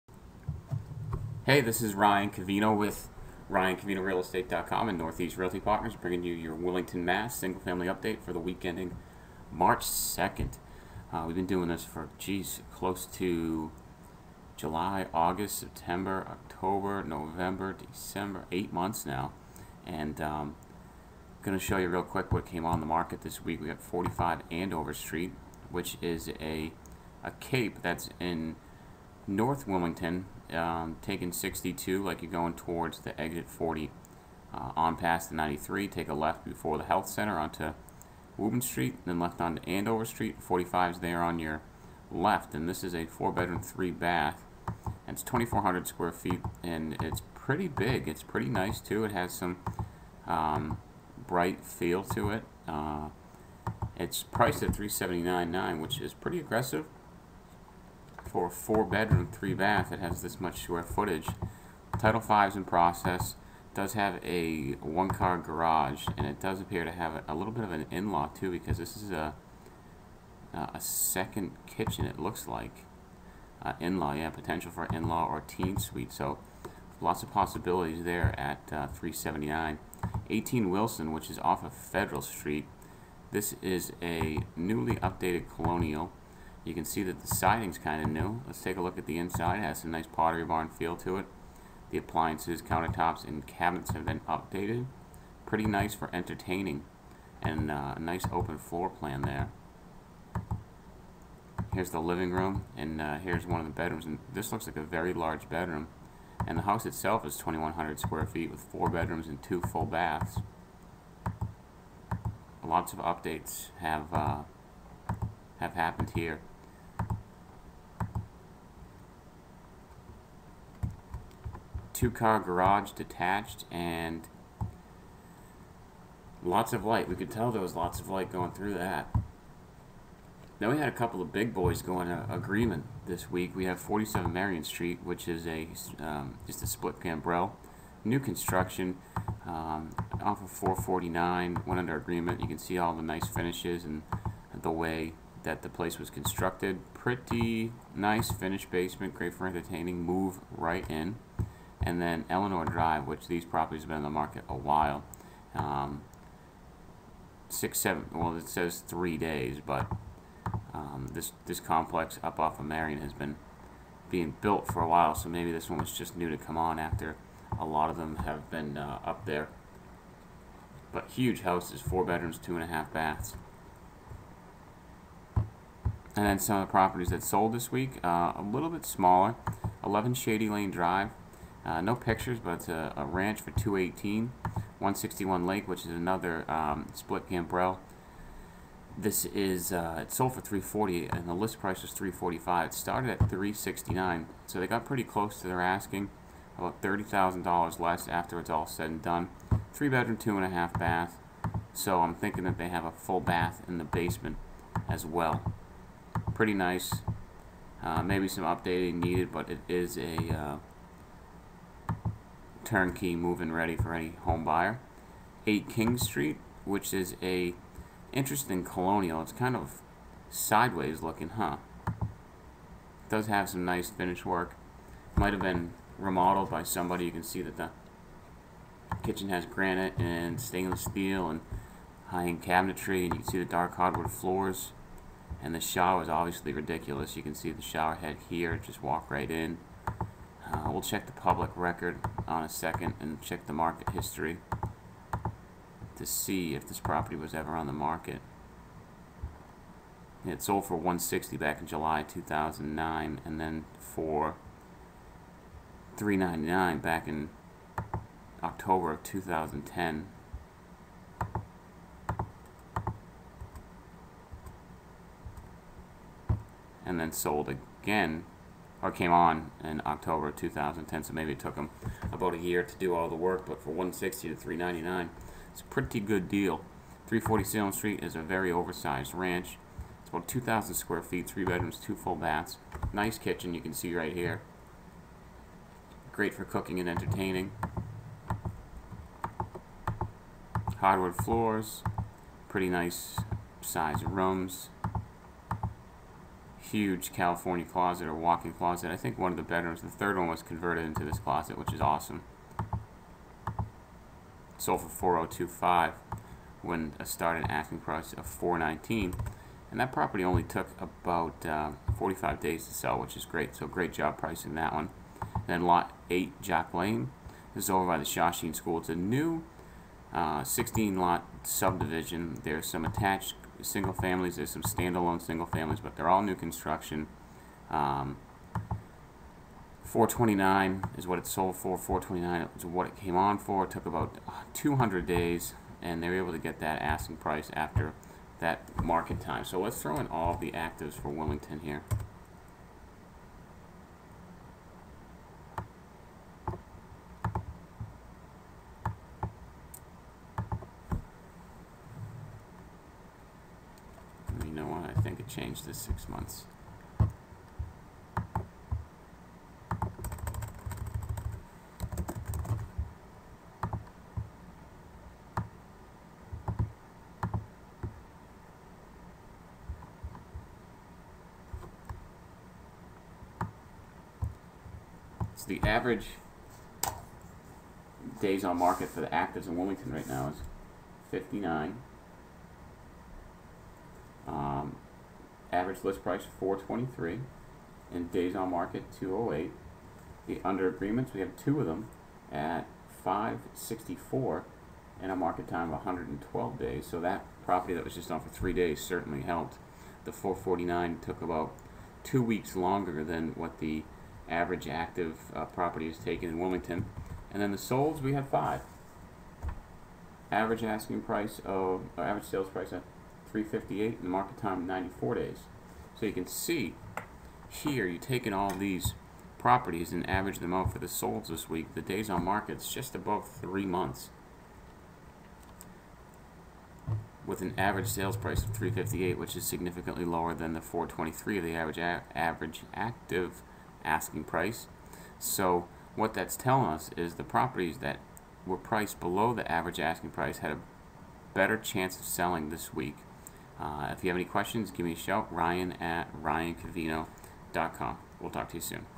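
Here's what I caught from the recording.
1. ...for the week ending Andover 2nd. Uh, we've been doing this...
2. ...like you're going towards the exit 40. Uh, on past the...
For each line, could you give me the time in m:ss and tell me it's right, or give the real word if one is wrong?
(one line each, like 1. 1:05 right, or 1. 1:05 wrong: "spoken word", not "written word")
1. 0:08 wrong: "March", not "Andover"
2. 0:32 right.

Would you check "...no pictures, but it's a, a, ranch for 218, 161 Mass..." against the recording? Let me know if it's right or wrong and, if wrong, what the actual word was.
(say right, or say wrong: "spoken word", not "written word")
wrong: "Lake", not "Mass".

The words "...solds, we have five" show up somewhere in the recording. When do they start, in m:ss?
6:47.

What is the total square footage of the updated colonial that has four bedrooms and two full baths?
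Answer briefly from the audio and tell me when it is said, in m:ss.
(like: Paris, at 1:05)
2,100, at 1:47.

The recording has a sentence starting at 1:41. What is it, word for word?
Here's the living room, and uh, here's one of the bedrooms.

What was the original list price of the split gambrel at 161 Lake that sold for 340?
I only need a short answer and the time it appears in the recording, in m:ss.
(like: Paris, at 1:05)
369, at 3:13.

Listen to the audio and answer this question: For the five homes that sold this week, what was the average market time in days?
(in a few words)
94.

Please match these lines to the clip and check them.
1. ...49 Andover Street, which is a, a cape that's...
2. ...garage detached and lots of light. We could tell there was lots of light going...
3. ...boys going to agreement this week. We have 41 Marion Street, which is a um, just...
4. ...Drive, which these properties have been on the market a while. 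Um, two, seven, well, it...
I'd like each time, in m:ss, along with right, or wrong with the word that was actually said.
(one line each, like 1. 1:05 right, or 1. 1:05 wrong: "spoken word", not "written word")
1. 0:23 wrong: "45", not "49"
2. 2:02 right
3. 2:11 wrong: "47", not "41"
4. 2:32 wrong: "six", not "two".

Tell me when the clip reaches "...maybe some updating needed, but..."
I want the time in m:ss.
3:28.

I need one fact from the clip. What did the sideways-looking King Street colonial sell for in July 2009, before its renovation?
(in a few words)
160.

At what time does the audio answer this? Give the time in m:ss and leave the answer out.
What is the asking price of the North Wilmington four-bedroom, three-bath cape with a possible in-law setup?
0:54.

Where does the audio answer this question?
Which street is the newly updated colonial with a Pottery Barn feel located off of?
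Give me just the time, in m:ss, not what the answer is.
1:21.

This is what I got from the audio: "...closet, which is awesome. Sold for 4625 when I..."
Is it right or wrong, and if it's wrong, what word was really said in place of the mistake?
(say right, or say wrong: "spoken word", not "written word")
wrong: "4025", not "4625".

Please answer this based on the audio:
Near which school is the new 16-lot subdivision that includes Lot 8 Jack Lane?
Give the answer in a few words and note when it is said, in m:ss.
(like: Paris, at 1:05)
Shawsheen School, at 5:18.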